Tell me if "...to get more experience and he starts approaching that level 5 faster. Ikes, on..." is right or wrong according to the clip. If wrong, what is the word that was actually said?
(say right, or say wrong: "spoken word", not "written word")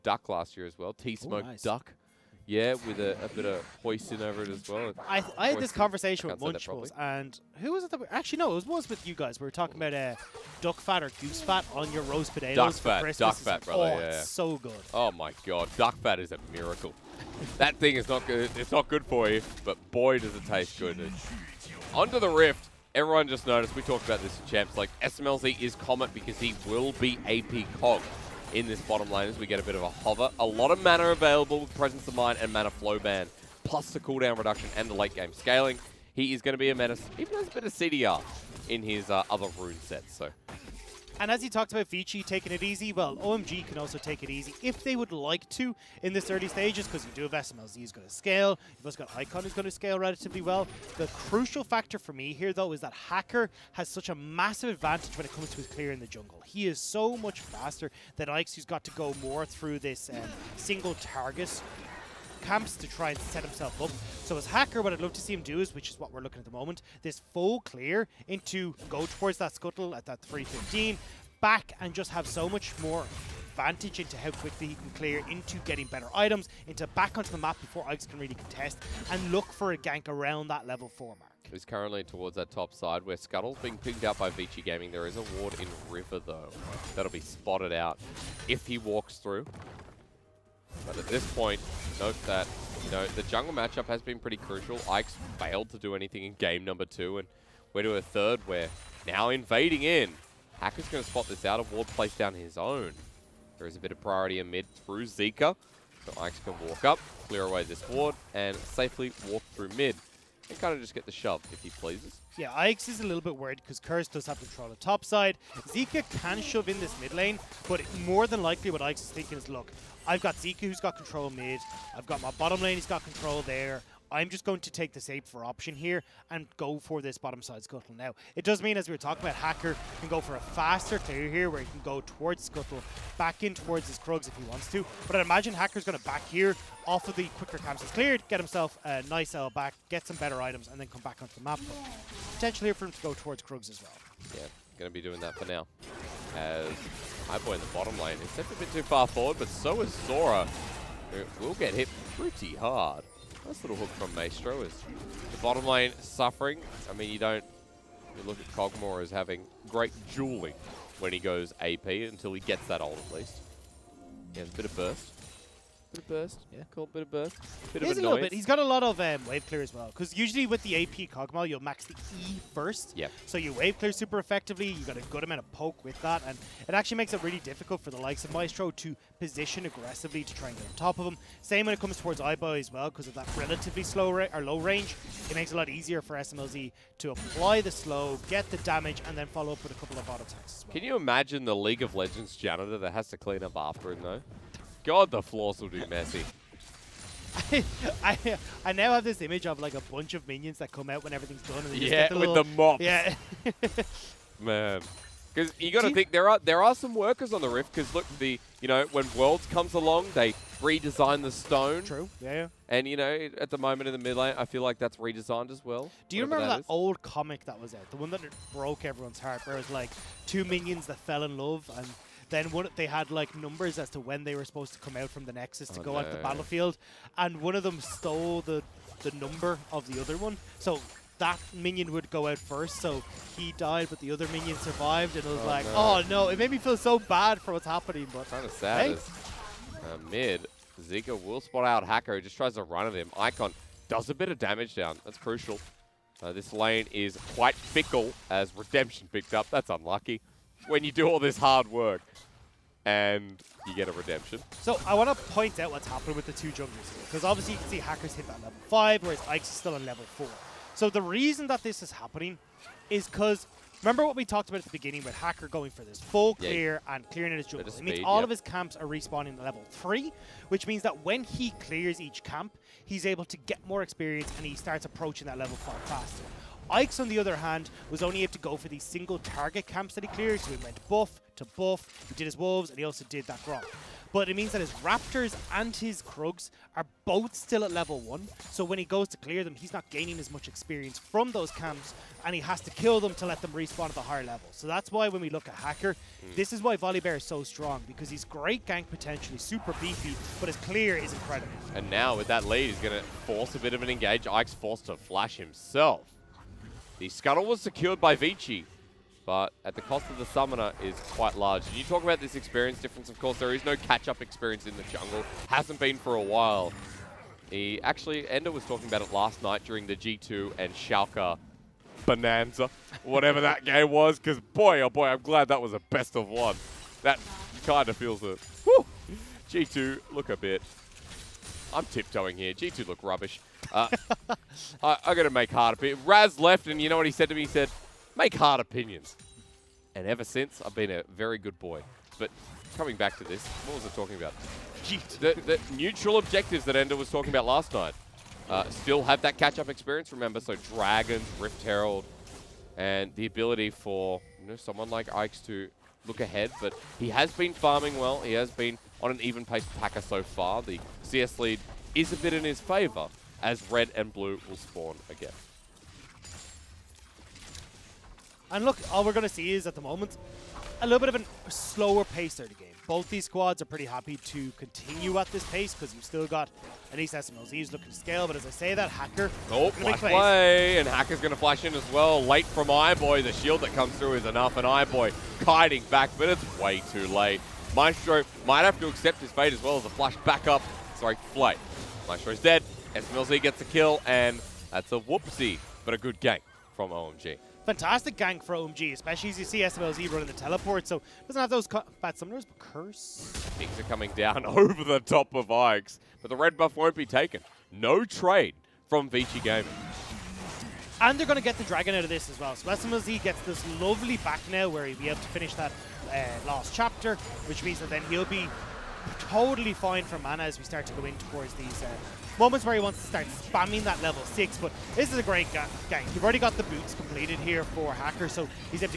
right.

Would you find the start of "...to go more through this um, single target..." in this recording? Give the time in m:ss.
0:58.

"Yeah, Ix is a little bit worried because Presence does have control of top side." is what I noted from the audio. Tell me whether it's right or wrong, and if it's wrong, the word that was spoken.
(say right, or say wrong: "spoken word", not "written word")
wrong: "Curse", not "Presence".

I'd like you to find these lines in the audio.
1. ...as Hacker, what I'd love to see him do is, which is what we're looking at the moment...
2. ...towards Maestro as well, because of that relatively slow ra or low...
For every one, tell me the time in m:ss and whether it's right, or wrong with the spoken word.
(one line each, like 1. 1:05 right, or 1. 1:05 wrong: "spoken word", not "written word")
1. 1:04 right
2. 3:01 wrong: "Ibo", not "Maestro".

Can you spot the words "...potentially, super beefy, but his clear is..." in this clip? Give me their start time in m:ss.
4:58.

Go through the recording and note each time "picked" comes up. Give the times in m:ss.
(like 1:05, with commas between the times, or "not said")
1:23, 4:09.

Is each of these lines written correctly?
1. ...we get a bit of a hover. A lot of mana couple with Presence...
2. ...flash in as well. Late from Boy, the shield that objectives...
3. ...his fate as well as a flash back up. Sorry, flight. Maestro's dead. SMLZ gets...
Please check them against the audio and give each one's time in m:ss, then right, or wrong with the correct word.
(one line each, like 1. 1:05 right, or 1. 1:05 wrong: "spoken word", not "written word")
1. 0:29 wrong: "available", not "couple"
2. 6:21 wrong: "comes", not "objectives"
3. 6:29 right.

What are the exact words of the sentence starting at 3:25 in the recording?
Because you got to think there are there are some workers on the rift.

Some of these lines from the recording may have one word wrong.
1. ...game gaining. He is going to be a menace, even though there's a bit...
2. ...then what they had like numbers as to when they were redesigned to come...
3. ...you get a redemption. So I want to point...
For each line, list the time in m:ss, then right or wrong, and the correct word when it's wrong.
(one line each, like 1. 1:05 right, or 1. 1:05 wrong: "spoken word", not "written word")
1. 0:35 wrong: "scaling", not "gaining"
2. 3:42 wrong: "supposed", not "redesigned"
3. 4:13 right.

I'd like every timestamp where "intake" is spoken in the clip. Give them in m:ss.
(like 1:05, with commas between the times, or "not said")
not said.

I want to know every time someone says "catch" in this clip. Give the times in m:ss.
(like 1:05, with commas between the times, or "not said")
5:13, 5:49.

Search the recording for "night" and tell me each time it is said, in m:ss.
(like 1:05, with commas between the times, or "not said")
5:19, 5:47.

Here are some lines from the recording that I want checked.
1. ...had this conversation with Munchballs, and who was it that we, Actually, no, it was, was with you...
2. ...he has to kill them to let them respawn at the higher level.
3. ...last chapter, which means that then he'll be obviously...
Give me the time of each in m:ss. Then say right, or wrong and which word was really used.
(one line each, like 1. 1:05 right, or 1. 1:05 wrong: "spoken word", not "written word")
1. 0:05 right
2. 4:52 right
3. 6:56 wrong: "totally", not "obviously".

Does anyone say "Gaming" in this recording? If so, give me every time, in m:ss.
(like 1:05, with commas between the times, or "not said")
1:24, 6:49.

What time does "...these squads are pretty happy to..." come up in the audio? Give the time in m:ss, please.
6:13.